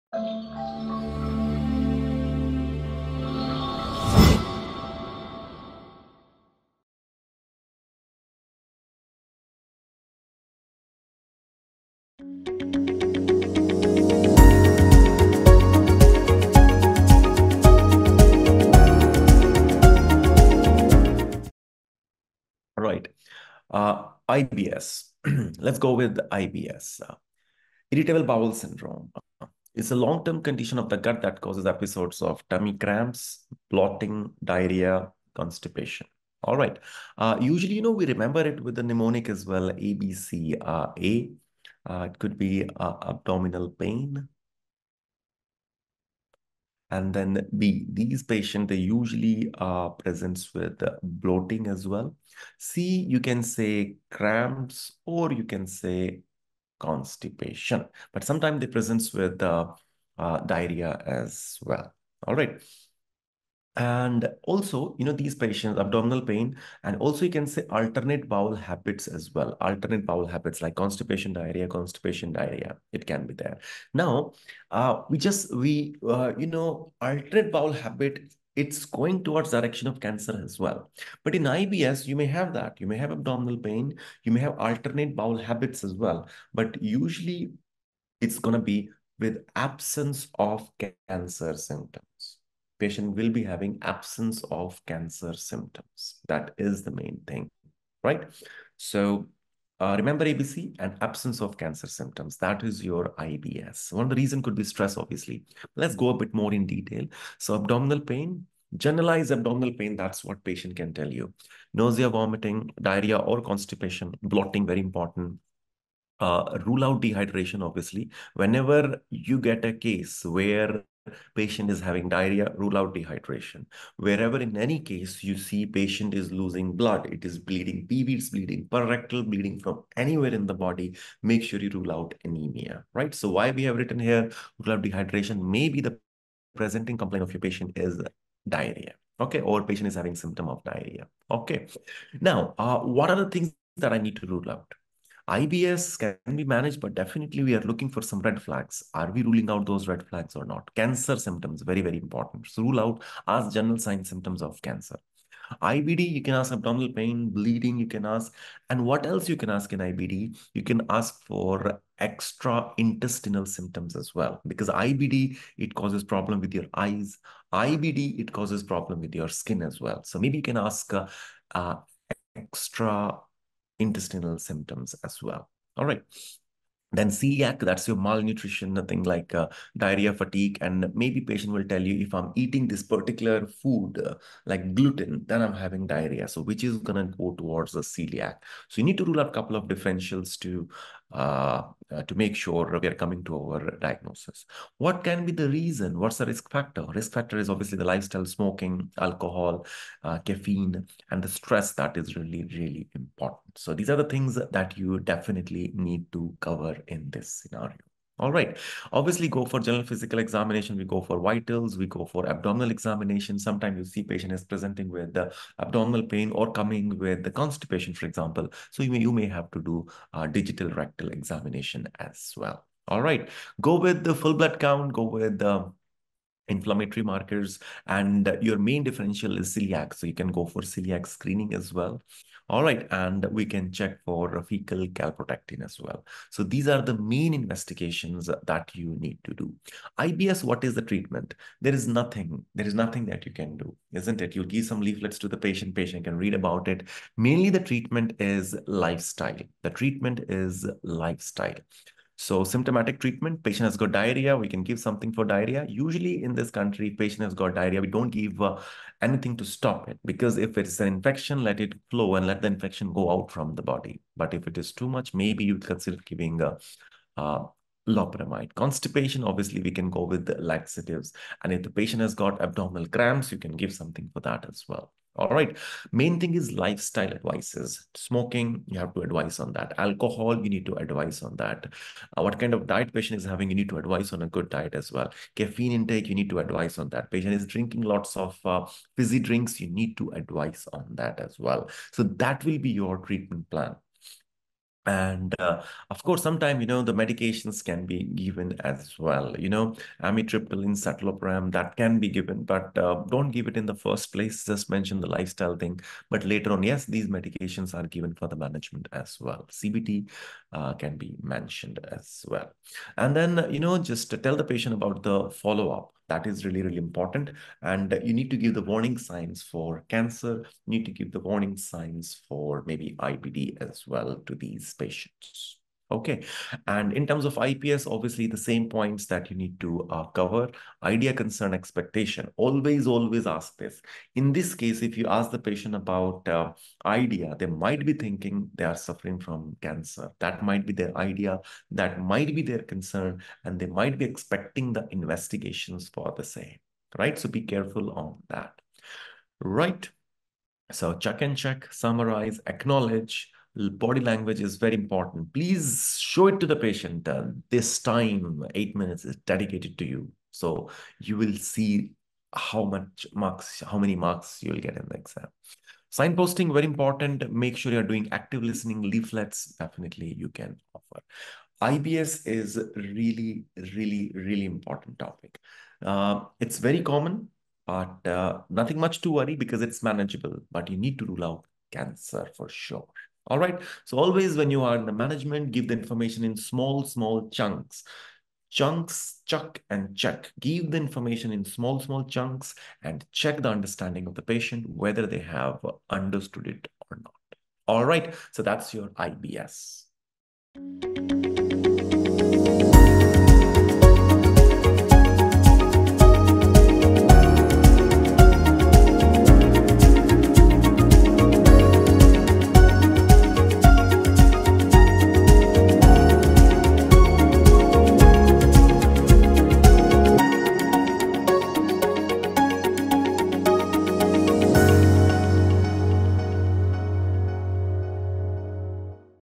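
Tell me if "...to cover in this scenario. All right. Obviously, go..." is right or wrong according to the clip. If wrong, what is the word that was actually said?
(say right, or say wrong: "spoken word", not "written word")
right.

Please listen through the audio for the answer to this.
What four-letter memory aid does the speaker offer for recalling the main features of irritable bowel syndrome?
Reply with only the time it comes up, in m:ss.
0:39.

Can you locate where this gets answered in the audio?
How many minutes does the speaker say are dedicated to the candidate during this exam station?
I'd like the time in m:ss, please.
5:58.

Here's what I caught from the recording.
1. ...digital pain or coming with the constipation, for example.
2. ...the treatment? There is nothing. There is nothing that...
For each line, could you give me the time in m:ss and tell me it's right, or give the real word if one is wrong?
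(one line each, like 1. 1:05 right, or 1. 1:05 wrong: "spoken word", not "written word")
1. 3:35 wrong: "abdominal", not "digital"
2. 4:00 right.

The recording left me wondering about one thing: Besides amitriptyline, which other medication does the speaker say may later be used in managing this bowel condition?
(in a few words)
citalopram.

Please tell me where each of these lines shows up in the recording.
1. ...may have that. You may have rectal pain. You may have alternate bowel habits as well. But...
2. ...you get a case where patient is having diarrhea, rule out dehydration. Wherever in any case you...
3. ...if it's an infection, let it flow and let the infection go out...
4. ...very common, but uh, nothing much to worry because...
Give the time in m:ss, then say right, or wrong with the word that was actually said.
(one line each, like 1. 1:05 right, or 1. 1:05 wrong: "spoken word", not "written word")
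1. 1:22 wrong: "abdominal", not "rectal"
2. 1:59 right
3. 4:20 right
4. 6:16 right.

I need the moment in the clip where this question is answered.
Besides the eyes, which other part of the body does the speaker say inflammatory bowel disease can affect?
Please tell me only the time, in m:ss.
2:49.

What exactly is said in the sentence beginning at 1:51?
Nausea, vomiting, diarrhea or constipation, blotting, very important.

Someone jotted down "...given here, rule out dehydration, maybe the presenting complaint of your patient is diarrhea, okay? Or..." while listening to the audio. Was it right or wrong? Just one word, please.
wrong.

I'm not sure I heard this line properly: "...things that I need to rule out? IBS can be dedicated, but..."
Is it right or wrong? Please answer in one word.
wrong.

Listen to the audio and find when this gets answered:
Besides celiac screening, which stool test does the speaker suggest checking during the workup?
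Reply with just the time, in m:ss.
3:54.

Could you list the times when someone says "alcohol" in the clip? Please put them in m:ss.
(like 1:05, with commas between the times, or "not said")
3:18, 4:39.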